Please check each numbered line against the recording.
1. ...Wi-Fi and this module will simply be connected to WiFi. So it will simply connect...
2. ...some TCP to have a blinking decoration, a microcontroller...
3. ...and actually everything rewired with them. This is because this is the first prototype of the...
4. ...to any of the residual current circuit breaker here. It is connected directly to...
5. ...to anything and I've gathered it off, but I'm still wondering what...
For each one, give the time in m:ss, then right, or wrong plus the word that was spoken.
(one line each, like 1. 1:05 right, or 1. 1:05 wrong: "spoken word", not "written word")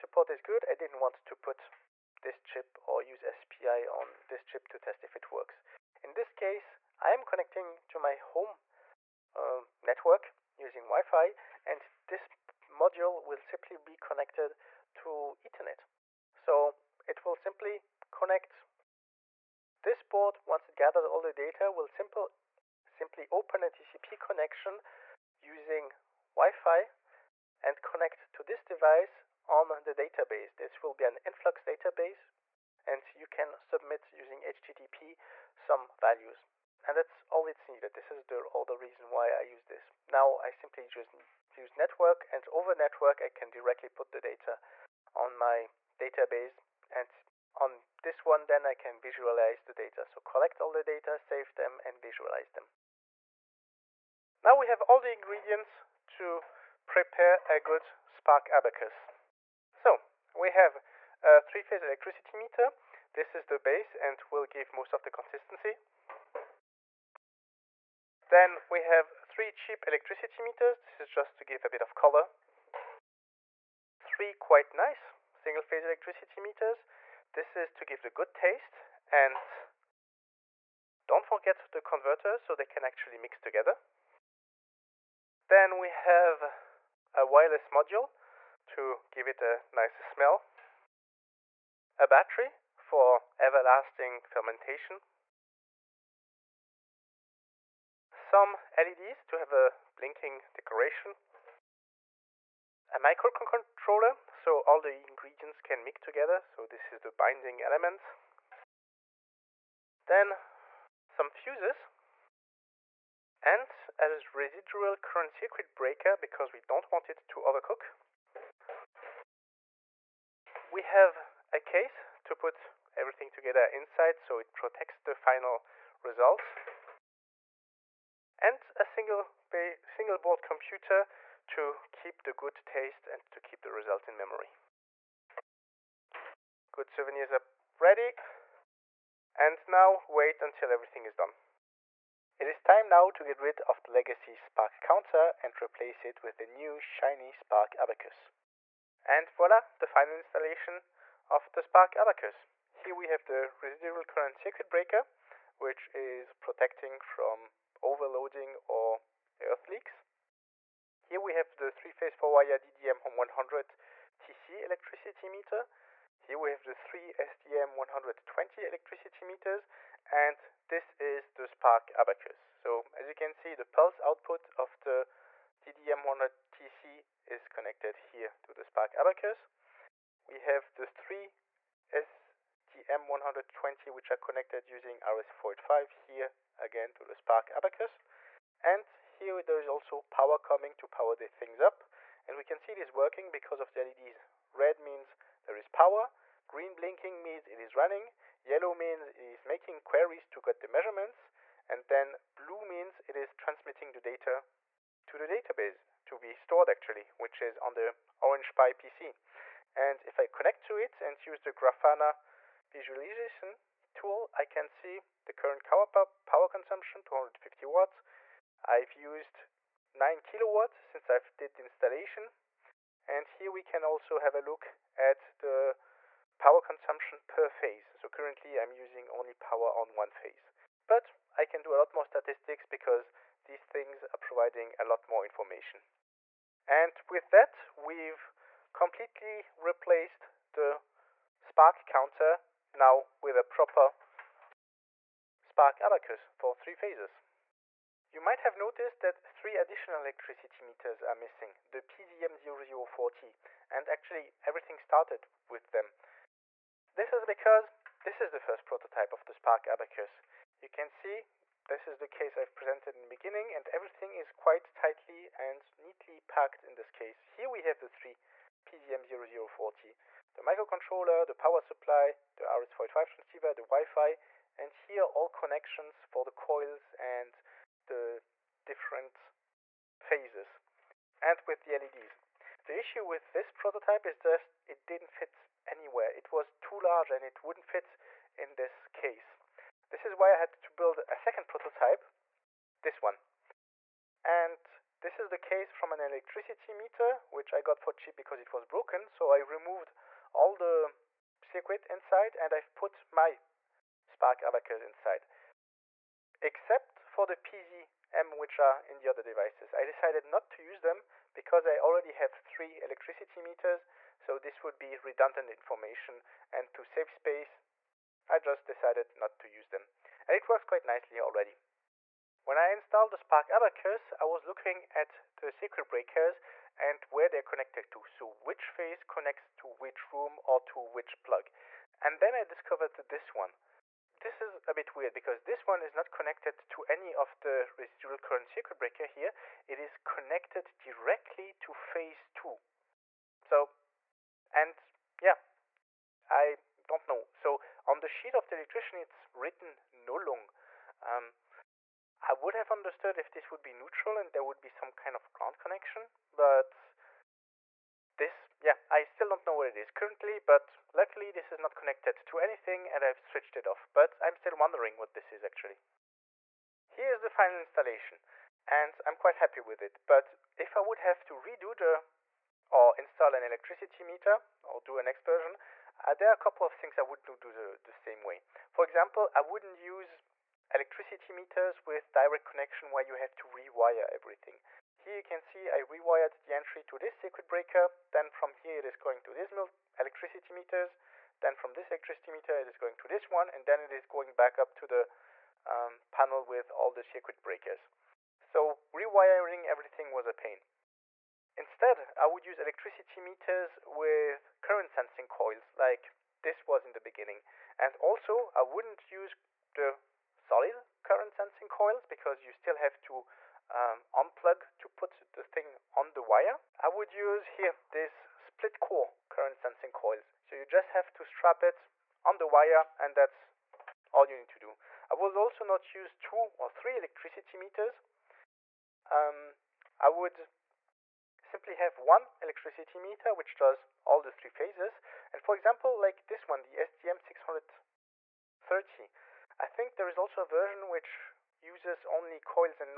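1. 0:10 wrong: "Ethernet", not "WiFi"
2. 1:38 wrong: "LEDs", not "TCP"
3. 4:13 wrong: "started", not "rewired"
4. 5:36 right
5. 6:02 wrong: "switched", not "gathered".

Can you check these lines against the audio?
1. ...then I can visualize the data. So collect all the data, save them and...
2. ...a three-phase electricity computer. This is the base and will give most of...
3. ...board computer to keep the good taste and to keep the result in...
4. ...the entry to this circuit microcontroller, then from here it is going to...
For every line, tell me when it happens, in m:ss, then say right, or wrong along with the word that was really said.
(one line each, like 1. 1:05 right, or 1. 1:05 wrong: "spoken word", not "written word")
1. 0:48 right
2. 1:01 wrong: "meter", not "computer"
3. 2:10 right
4. 6:26 wrong: "breaker", not "microcontroller".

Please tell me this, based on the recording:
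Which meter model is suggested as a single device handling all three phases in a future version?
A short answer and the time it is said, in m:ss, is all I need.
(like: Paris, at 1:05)
SDM630, at 7:16.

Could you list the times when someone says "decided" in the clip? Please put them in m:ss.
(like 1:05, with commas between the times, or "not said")
5:09, 5:18.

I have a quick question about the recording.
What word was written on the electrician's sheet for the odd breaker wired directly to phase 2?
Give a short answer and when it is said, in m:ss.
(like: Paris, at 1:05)
Nullung, at 5:49.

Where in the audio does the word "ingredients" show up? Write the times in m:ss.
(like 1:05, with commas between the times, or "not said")
0:55, 1:45.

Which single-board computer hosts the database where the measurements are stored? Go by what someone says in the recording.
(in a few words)
Orange Pi PC.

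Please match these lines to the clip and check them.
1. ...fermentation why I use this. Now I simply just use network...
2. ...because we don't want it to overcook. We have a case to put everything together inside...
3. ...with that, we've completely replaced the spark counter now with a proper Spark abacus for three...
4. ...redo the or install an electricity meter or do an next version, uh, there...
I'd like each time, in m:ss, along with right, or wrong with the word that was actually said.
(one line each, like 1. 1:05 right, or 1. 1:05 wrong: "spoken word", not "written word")
1. 0:38 wrong: "reason", not "fermentation"
2. 1:56 right
3. 3:57 right
4. 6:11 right.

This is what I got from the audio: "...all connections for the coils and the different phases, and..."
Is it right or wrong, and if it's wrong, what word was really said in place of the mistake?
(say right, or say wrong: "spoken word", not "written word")
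right.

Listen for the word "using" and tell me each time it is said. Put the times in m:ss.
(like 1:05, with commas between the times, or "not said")
0:10, 0:25, 0:34, 3:04, 3:48.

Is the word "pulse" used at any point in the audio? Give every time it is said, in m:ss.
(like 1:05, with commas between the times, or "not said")
2:53.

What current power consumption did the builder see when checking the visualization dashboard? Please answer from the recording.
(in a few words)
250 watts.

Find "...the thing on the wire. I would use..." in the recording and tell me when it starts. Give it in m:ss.
6:55.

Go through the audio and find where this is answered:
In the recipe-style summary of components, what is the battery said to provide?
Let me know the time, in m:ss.
1:33.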